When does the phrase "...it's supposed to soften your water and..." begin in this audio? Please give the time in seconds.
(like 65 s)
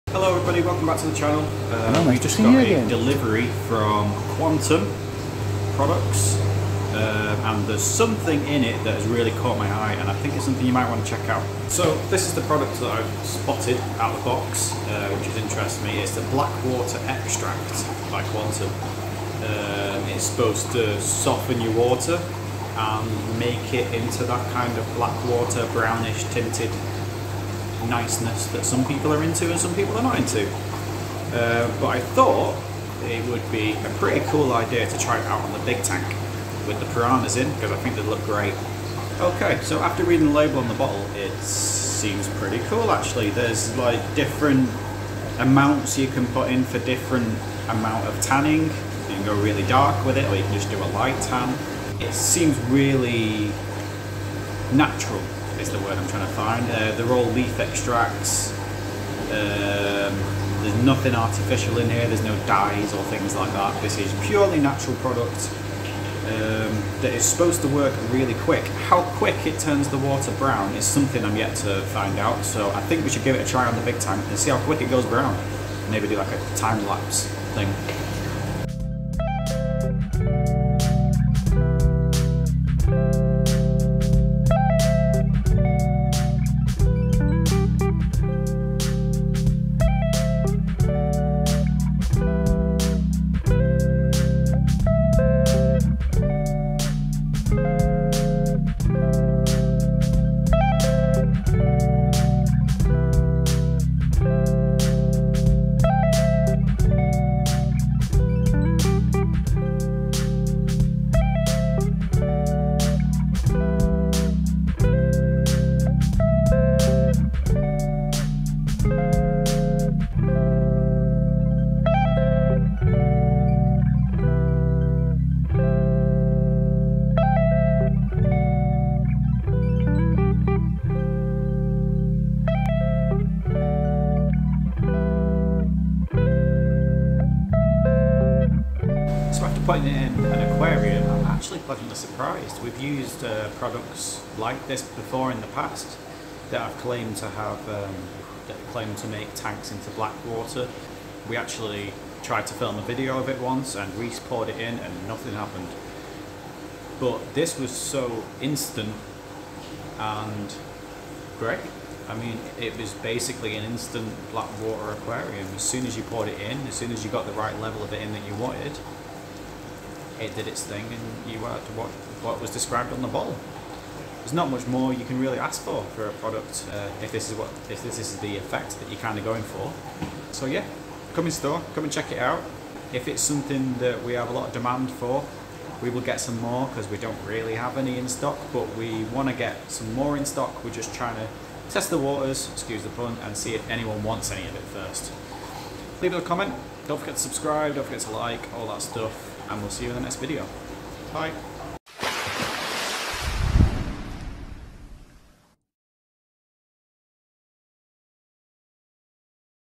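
20 s.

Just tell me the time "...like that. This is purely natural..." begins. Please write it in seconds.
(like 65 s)
63 s.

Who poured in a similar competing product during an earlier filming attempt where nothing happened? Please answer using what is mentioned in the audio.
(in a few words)
Reese.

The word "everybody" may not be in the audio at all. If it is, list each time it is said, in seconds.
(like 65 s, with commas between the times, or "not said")
0 s.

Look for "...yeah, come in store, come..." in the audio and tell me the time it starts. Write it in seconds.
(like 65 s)
180 s.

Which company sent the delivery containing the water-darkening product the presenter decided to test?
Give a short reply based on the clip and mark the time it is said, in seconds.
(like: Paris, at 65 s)
Quantum Products, at 4 s.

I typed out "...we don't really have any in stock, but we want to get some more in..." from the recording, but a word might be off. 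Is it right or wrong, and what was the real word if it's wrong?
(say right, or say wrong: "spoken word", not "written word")
right.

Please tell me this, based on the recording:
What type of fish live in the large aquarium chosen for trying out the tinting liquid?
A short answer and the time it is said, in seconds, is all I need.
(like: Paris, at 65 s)
piranhas, at 36 s.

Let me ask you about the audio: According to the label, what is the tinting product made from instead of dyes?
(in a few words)
leaf extracts.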